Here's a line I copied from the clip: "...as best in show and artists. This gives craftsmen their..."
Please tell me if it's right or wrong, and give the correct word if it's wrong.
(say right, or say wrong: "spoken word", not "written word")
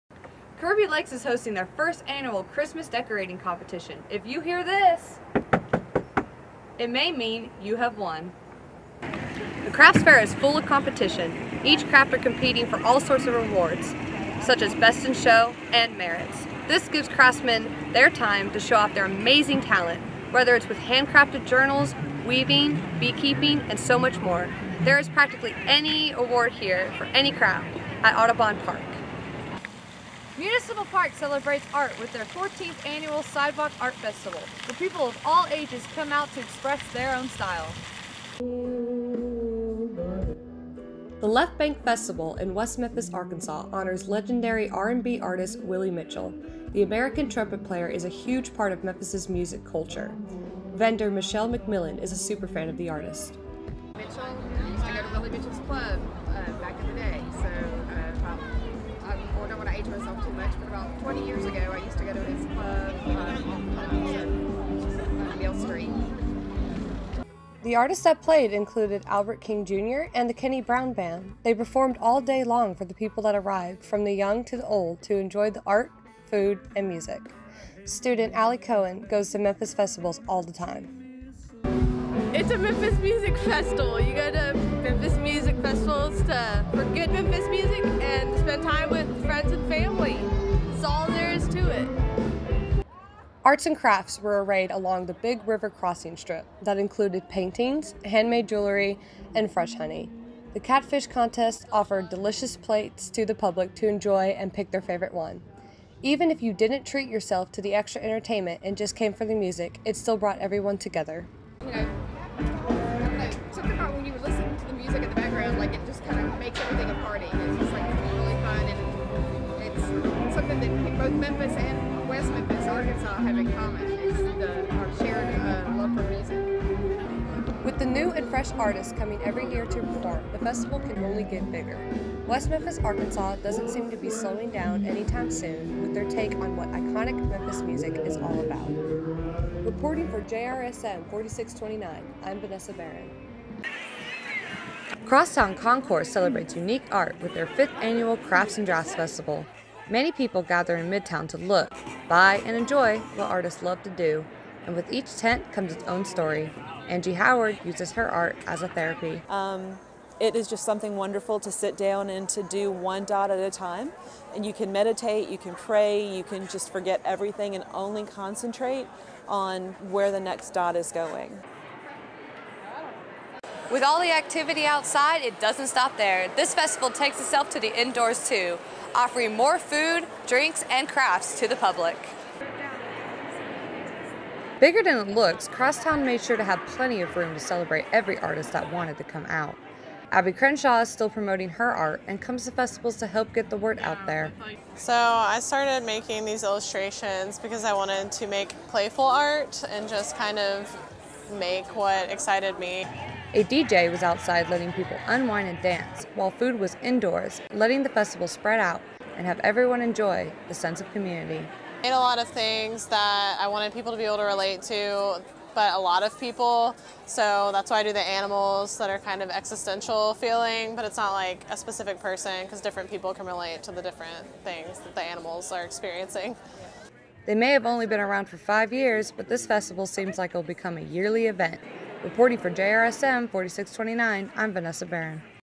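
wrong: "merits", not "artists".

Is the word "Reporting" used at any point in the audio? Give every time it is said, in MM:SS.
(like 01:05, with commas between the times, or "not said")
02:19, 03:52.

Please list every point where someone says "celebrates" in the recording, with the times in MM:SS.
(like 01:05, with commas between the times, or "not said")
00:31, 02:26, 03:07.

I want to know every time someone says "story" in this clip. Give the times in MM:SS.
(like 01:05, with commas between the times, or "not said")
02:36.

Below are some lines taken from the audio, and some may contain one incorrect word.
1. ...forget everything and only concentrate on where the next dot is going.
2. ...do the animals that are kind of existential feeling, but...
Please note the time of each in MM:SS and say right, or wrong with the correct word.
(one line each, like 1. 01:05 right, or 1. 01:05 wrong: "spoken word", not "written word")
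1. 02:46 right
2. 03:37 right.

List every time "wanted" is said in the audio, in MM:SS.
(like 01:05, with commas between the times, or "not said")
03:08, 03:17, 03:33.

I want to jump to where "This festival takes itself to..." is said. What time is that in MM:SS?
02:56.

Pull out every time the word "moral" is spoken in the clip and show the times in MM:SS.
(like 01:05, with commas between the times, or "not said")
not said.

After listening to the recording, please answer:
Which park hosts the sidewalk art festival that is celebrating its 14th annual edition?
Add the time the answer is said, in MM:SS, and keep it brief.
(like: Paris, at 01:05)
Municipal Park, at 00:30.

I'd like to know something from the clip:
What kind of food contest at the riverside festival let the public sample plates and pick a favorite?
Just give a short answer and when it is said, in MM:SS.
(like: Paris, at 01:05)
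Catfish contest, at 01:40.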